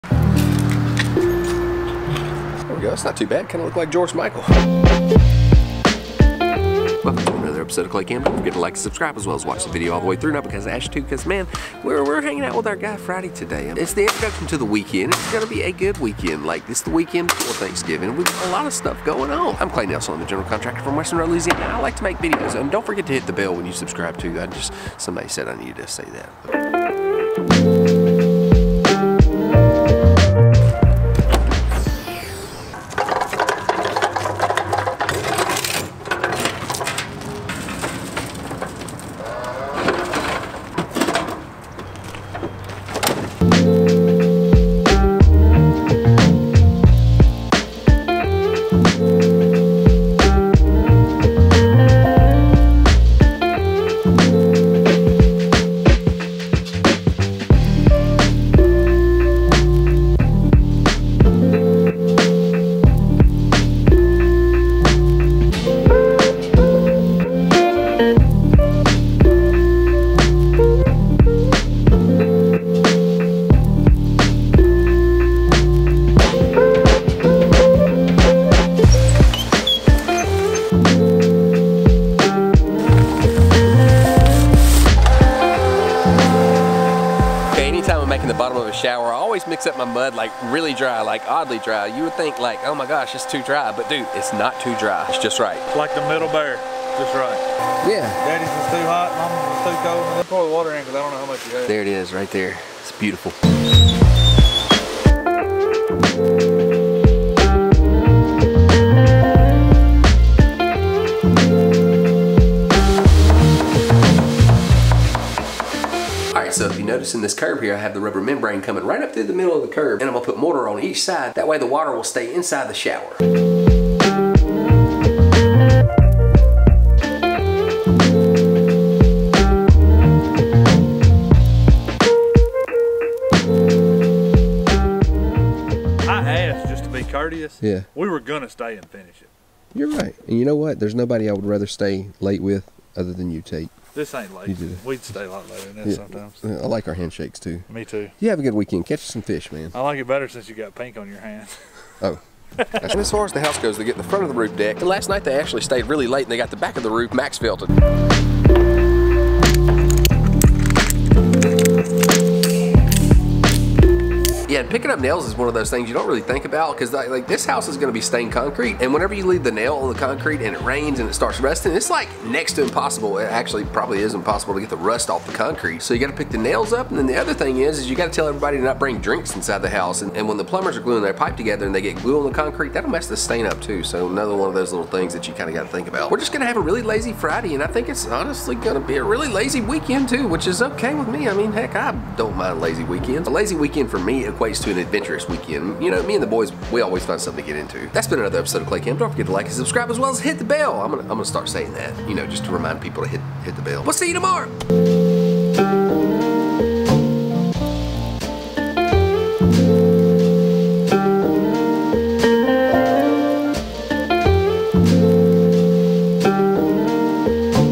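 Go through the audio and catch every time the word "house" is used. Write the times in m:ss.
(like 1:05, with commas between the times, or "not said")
2:33, 2:47, 2:59.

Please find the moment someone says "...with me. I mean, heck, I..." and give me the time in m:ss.
3:10.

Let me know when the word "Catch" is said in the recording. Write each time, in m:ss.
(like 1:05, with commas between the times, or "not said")
2:28.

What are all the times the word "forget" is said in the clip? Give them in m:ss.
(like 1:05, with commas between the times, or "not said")
0:08, 0:22, 3:19.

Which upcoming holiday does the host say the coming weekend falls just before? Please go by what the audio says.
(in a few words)
Thanksgiving.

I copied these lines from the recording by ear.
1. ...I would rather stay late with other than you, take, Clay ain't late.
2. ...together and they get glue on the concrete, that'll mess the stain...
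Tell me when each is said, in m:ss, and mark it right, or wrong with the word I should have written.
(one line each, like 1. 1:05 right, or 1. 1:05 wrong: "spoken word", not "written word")
1. 2:21 wrong: "This", not "Clay"
2. 3:01 right.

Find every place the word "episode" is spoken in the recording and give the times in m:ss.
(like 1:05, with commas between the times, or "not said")
0:07, 3:18.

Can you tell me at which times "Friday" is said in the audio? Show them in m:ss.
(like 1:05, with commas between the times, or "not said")
0:12, 3:07.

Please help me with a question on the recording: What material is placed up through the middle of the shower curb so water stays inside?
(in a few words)
rubber membrane.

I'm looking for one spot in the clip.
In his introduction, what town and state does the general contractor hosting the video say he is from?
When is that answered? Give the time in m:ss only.
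0:20.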